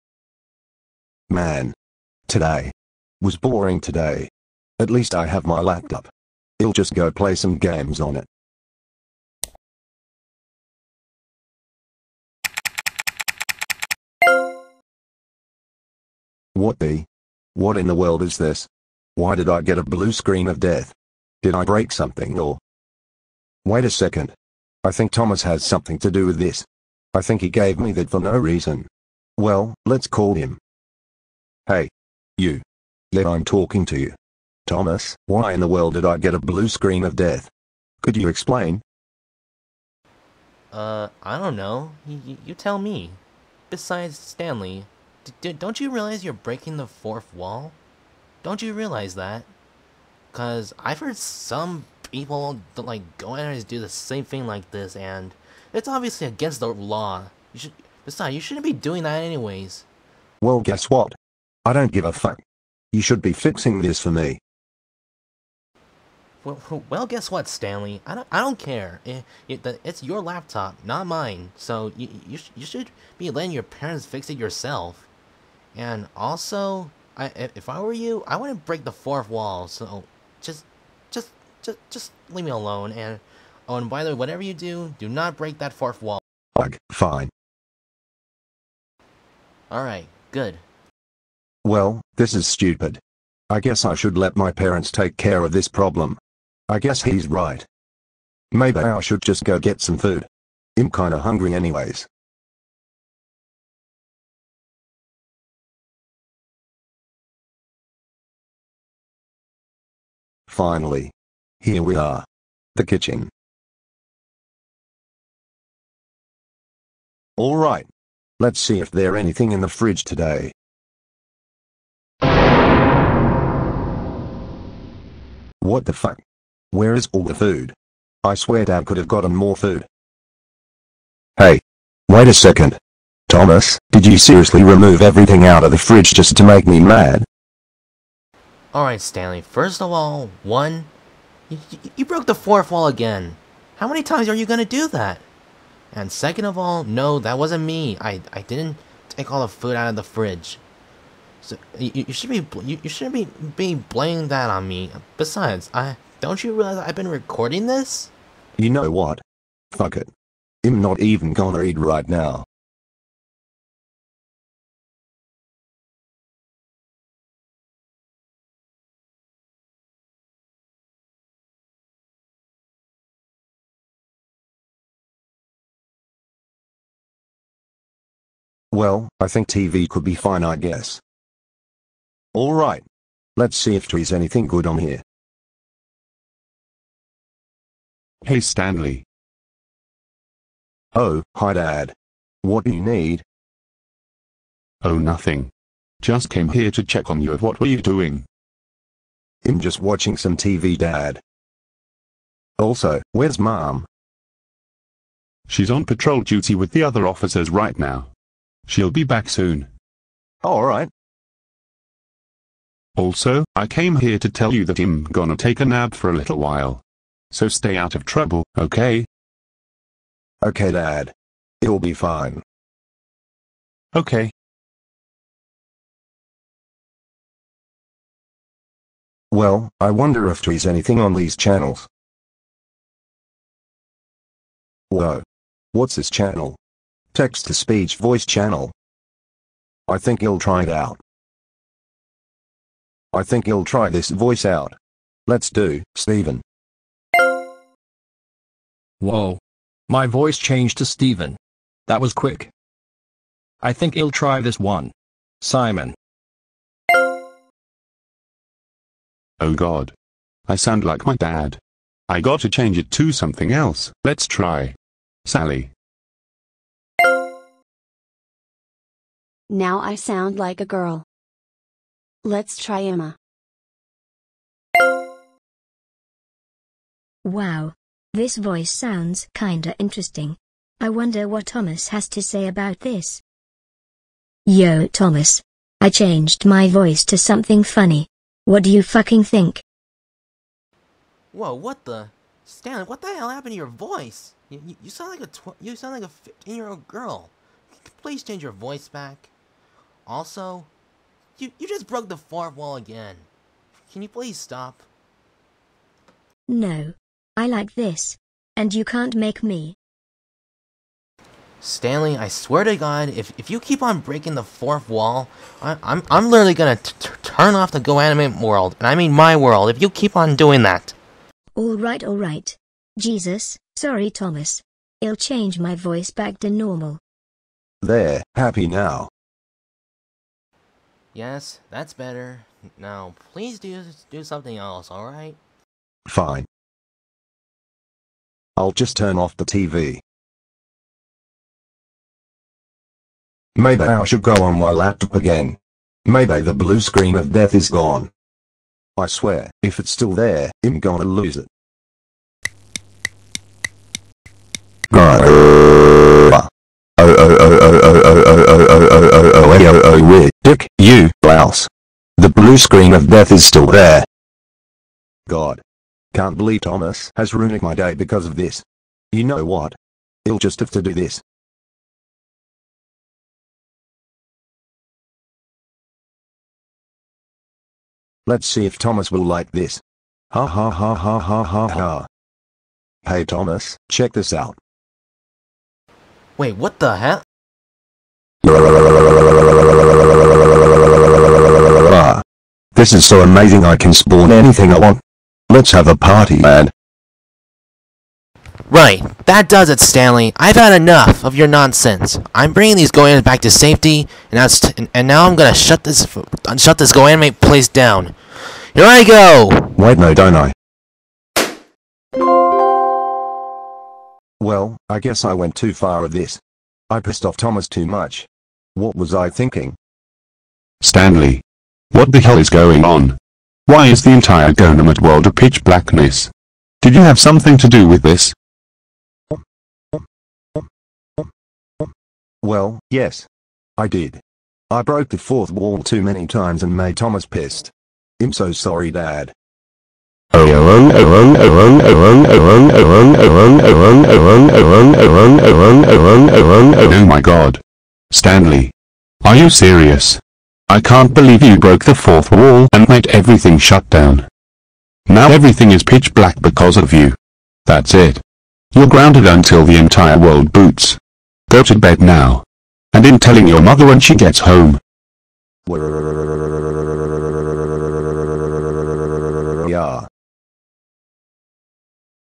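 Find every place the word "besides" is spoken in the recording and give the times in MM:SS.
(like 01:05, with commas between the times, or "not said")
00:43, 00:58, 02:35.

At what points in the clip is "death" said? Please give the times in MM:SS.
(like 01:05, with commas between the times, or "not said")
00:20, 00:37, 05:47, 06:03.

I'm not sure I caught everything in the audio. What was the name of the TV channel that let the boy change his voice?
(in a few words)
Text-to-speech voice channel.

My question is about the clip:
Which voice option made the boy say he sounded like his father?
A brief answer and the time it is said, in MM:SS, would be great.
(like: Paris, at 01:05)
Simon, at 04:15.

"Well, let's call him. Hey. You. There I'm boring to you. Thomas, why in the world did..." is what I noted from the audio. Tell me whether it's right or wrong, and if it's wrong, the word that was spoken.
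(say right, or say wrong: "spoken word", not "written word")
wrong: "talking", not "boring".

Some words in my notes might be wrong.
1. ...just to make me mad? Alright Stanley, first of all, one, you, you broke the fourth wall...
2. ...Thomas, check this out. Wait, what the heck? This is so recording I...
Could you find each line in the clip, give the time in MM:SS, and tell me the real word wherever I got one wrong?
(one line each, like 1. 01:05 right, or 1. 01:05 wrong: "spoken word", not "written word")
1. 02:16 right
2. 06:23 wrong: "amazing", not "recording".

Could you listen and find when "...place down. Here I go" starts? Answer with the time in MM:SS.
06:47.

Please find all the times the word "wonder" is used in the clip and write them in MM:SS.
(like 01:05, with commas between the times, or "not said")
03:49, 04:40.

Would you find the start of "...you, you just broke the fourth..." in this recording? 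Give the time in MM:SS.
05:01.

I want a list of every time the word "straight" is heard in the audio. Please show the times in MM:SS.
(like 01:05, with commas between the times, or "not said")
not said.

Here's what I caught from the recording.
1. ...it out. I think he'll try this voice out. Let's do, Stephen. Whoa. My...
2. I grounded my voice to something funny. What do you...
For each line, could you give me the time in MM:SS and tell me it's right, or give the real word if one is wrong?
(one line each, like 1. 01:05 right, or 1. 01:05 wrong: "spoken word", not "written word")
1. 04:00 right
2. 04:45 wrong: "changed", not "grounded".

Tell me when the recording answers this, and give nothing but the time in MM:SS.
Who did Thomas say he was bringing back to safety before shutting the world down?
06:42.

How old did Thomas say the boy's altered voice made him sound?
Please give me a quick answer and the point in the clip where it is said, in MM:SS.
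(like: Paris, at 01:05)
15, at 04:56.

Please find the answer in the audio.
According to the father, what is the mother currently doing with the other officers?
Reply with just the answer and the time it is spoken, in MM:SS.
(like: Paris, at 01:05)
Patrol duty, at 03:25.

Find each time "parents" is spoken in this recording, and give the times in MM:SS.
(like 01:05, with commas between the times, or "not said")
01:13, 01:34.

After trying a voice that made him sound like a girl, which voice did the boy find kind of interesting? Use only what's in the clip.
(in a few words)
Emma.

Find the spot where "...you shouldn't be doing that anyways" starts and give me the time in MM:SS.
00:58.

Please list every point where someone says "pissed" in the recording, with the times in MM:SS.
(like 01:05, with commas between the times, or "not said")
06:56, 07:17.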